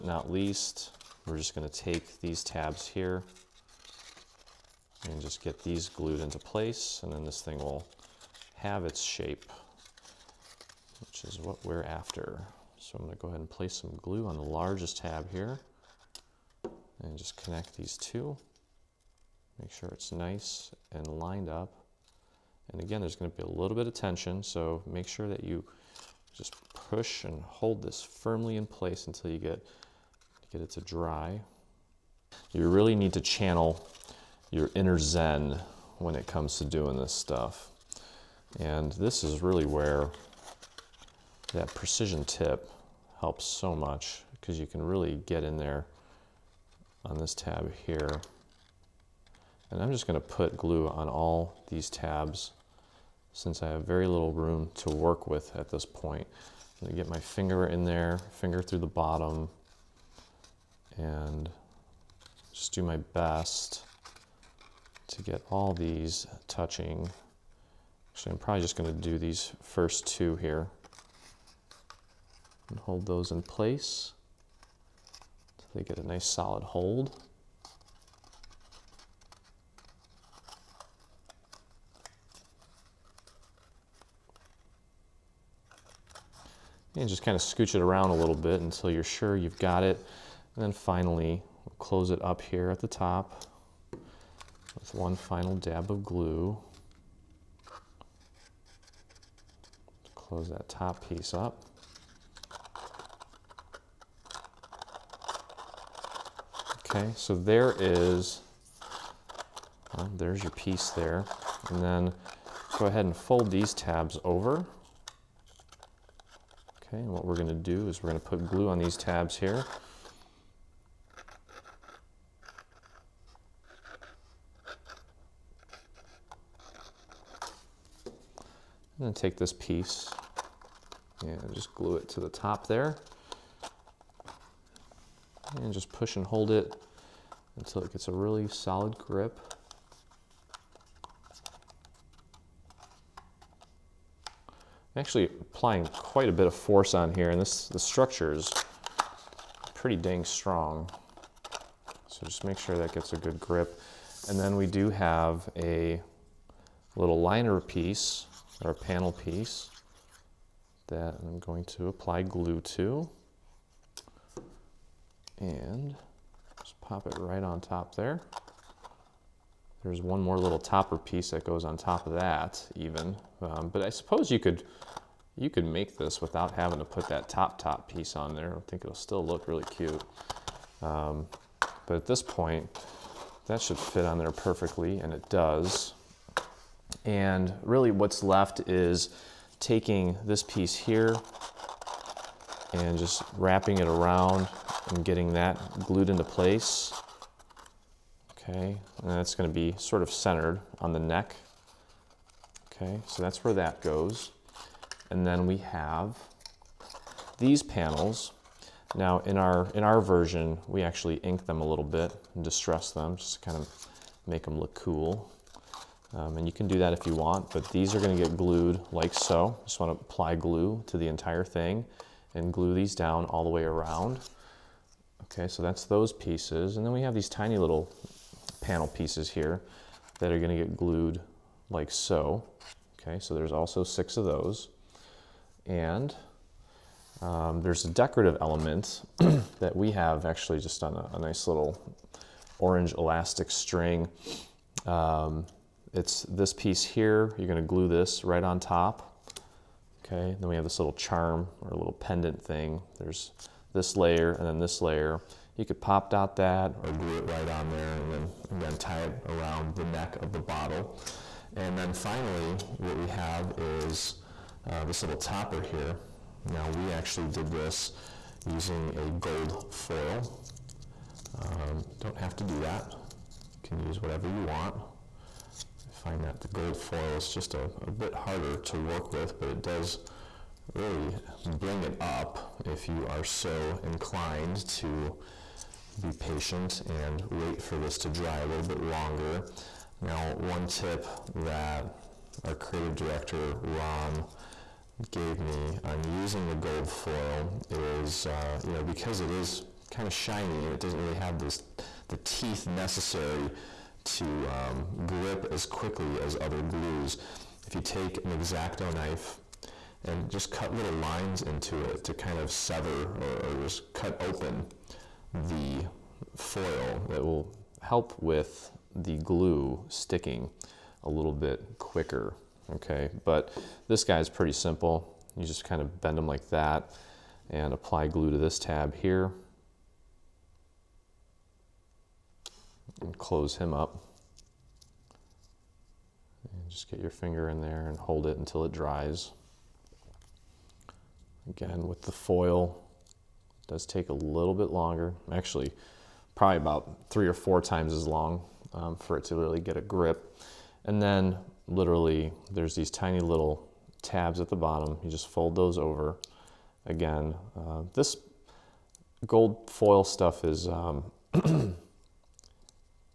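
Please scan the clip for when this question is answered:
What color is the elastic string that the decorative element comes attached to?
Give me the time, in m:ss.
4:02.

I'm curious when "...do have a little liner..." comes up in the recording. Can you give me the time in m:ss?
2:34.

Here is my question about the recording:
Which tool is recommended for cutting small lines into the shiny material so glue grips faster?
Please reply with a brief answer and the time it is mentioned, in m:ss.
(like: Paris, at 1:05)
X-Acto knife, at 5:08.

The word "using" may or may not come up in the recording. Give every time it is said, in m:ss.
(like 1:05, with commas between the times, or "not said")
4:28, 4:56.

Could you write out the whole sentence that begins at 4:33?
You can use whatever you want.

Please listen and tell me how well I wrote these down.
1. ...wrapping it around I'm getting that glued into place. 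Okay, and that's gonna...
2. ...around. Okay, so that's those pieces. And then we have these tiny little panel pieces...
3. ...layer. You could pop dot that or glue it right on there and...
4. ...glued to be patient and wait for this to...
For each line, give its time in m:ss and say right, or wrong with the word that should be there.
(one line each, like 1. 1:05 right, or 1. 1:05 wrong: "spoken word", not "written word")
1. 3:13 right
2. 3:43 right
3. 4:14 right
4. 4:43 wrong: "inclined", not "glued".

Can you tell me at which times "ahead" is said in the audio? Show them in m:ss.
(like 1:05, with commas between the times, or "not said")
0:13, 1:52.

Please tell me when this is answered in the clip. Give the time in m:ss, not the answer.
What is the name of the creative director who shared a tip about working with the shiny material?
4:53.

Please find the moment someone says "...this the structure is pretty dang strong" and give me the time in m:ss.
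2:27.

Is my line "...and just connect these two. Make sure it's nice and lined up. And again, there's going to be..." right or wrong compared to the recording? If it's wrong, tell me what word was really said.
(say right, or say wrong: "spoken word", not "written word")
right.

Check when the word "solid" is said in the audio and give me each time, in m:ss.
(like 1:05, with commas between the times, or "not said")
1:16, 2:18.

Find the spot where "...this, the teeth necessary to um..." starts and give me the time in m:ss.
5:01.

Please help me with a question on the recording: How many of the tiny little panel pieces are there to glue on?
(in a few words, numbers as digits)
6.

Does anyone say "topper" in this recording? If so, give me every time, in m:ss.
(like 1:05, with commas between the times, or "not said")
2:50, 4:25.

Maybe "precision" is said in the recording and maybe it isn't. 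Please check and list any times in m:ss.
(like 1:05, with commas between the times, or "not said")
0:41.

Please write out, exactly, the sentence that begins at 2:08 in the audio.
And then take this piece and just glue it to the top there.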